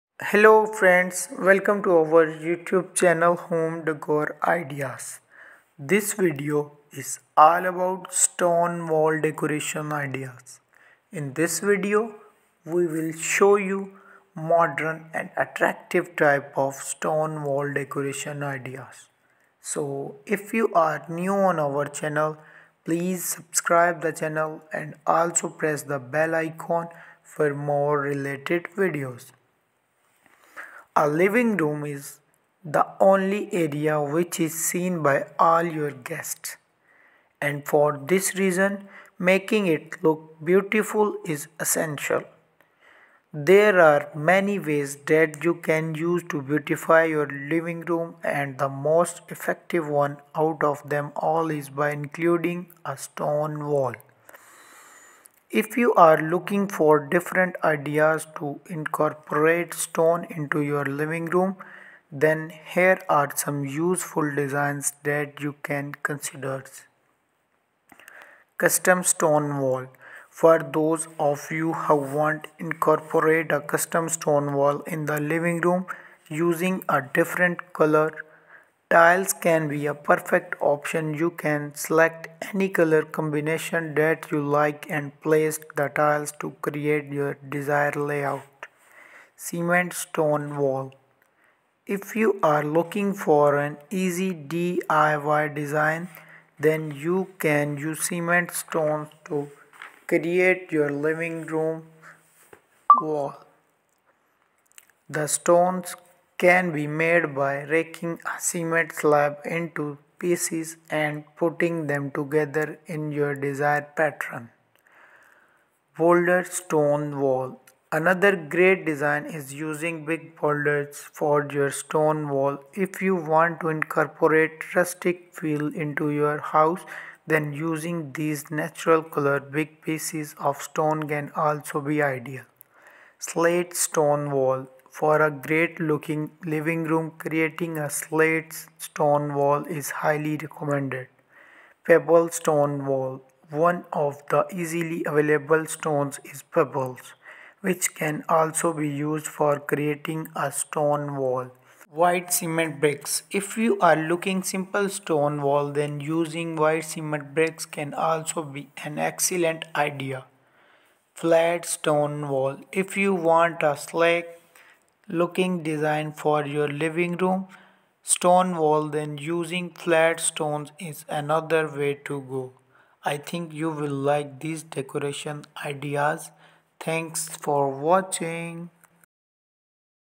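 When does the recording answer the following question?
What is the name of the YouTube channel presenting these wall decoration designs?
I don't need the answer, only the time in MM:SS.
00:03.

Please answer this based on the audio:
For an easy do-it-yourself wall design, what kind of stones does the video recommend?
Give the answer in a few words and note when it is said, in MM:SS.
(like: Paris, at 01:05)
cement stones, at 01:38.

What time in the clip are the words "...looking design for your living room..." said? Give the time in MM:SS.
02:45.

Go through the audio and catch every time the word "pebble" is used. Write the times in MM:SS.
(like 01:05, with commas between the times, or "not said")
02:21, 02:26.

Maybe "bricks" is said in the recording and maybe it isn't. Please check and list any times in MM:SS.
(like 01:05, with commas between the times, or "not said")
02:32, 02:37.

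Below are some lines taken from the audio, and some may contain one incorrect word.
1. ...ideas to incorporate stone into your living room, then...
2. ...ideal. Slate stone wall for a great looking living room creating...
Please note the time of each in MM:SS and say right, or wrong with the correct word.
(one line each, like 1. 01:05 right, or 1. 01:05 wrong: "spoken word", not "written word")
1. 00:57 right
2. 02:12 right.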